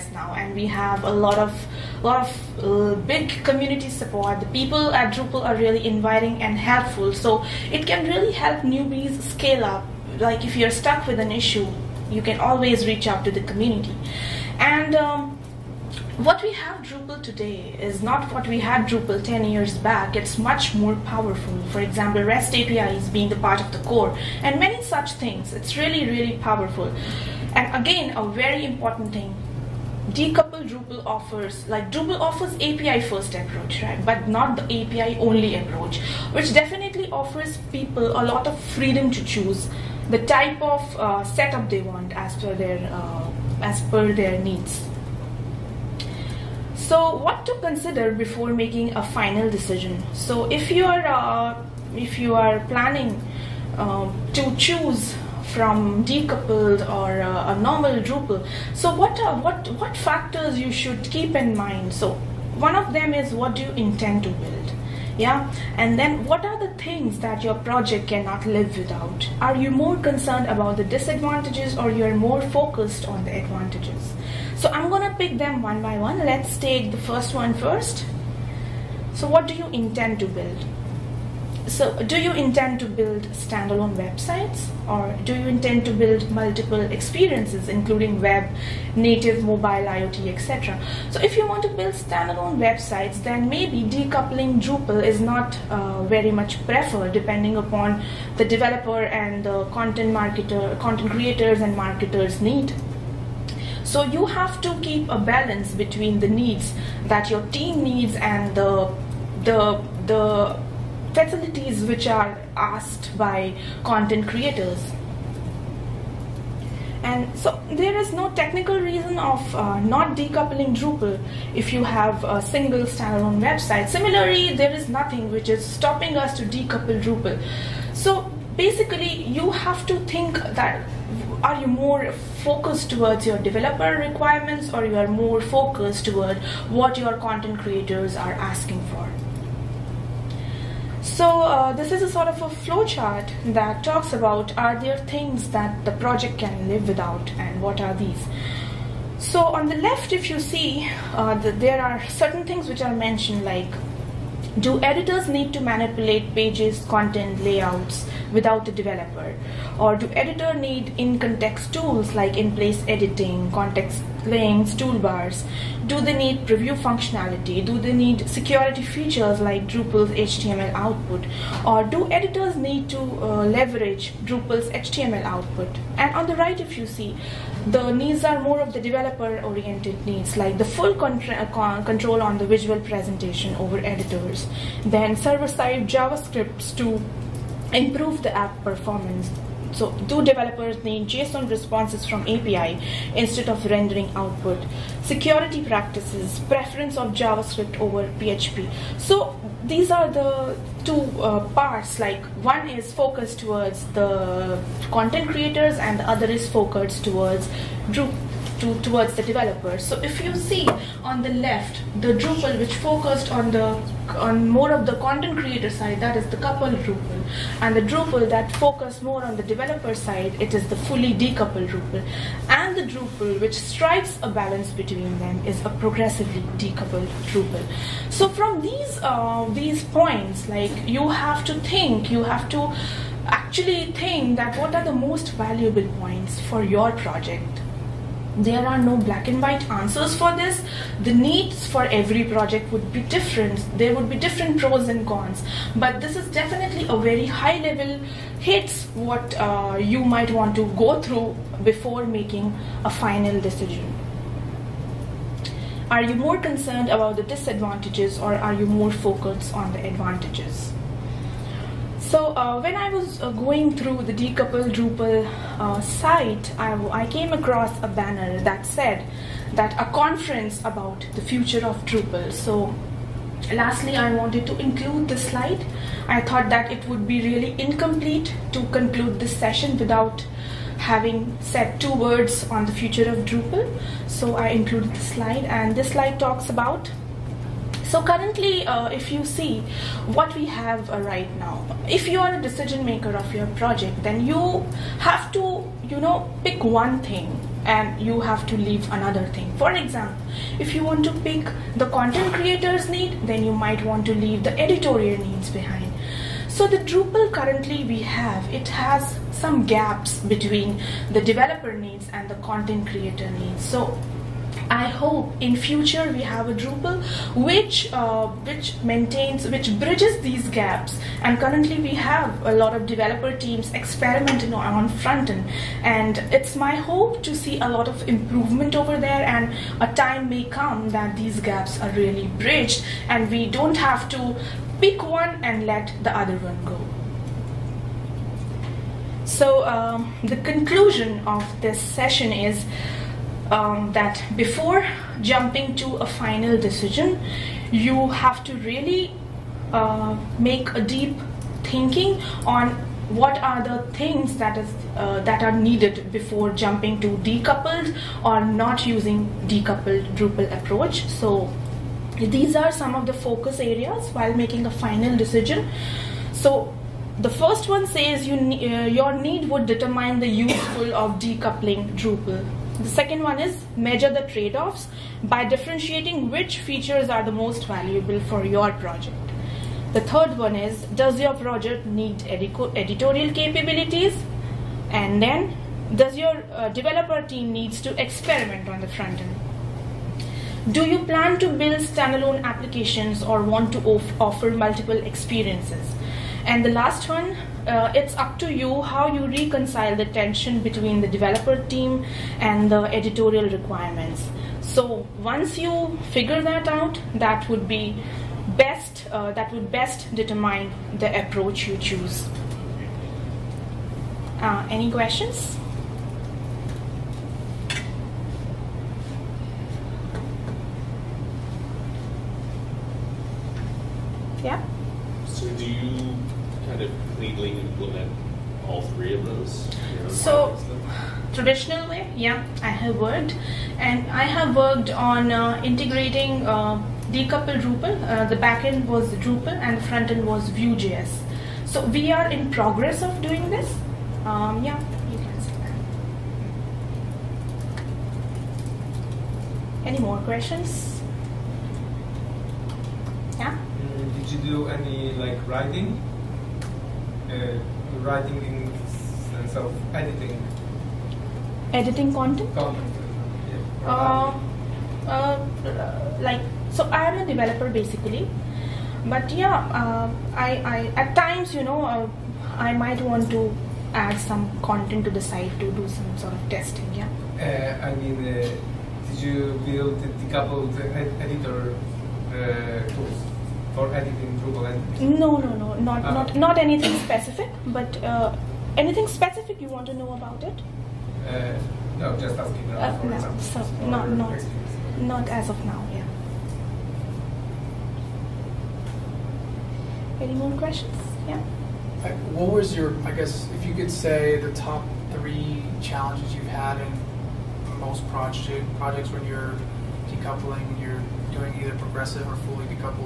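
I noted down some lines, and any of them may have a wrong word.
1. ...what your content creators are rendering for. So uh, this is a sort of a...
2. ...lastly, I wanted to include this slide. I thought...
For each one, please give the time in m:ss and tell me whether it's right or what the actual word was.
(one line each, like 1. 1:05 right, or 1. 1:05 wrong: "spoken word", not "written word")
1. 2:16 wrong: "asking", not "rendering"
2. 4:33 right.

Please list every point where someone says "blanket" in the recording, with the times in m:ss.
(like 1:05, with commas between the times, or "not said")
not said.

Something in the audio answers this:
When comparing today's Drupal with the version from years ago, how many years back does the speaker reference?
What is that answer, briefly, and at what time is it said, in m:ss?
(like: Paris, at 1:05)
10, at 0:19.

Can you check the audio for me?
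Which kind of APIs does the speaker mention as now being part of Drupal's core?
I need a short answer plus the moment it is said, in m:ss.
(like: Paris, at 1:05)
REST APIs, at 0:22.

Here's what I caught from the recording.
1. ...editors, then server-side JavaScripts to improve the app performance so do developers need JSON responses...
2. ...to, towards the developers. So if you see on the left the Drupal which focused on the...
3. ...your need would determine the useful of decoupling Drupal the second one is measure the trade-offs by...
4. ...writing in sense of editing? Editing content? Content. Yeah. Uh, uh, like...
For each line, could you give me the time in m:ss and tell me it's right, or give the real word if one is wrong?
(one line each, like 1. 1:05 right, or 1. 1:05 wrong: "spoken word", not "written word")
1. 3:03 right
2. 3:28 right
3. 6:08 right
4. 7:38 right.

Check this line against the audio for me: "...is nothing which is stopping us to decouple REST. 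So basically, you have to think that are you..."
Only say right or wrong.
wrong.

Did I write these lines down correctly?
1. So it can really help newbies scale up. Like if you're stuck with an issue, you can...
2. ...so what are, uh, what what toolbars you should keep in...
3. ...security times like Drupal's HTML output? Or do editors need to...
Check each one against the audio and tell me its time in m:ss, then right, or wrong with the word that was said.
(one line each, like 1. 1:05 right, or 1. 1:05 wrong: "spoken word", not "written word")
1. 0:07 right
2. 0:58 wrong: "factors", not "toolbars"
3. 2:48 wrong: "features", not "times".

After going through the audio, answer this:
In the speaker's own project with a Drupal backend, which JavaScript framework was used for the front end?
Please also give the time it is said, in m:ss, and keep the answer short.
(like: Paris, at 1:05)
Vue.js, at 7:20.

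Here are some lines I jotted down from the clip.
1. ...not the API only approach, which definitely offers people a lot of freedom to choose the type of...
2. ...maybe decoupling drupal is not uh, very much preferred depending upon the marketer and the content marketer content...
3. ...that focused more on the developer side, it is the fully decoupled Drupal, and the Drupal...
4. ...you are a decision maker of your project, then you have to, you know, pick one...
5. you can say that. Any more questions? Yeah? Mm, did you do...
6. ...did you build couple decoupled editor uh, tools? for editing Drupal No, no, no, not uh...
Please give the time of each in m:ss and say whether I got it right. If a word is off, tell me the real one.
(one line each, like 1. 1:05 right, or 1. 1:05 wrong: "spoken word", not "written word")
1. 0:34 right
2. 1:33 wrong: "developer", not "marketer"
3. 3:38 right
4. 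4:52 right
5. 7:25 right
6. 7:59 right.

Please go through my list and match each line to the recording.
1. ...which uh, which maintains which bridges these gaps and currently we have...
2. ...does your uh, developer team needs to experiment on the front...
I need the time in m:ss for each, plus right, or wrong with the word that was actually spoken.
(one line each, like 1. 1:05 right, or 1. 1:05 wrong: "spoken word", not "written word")
1. 5:17 right
2. 6:25 right.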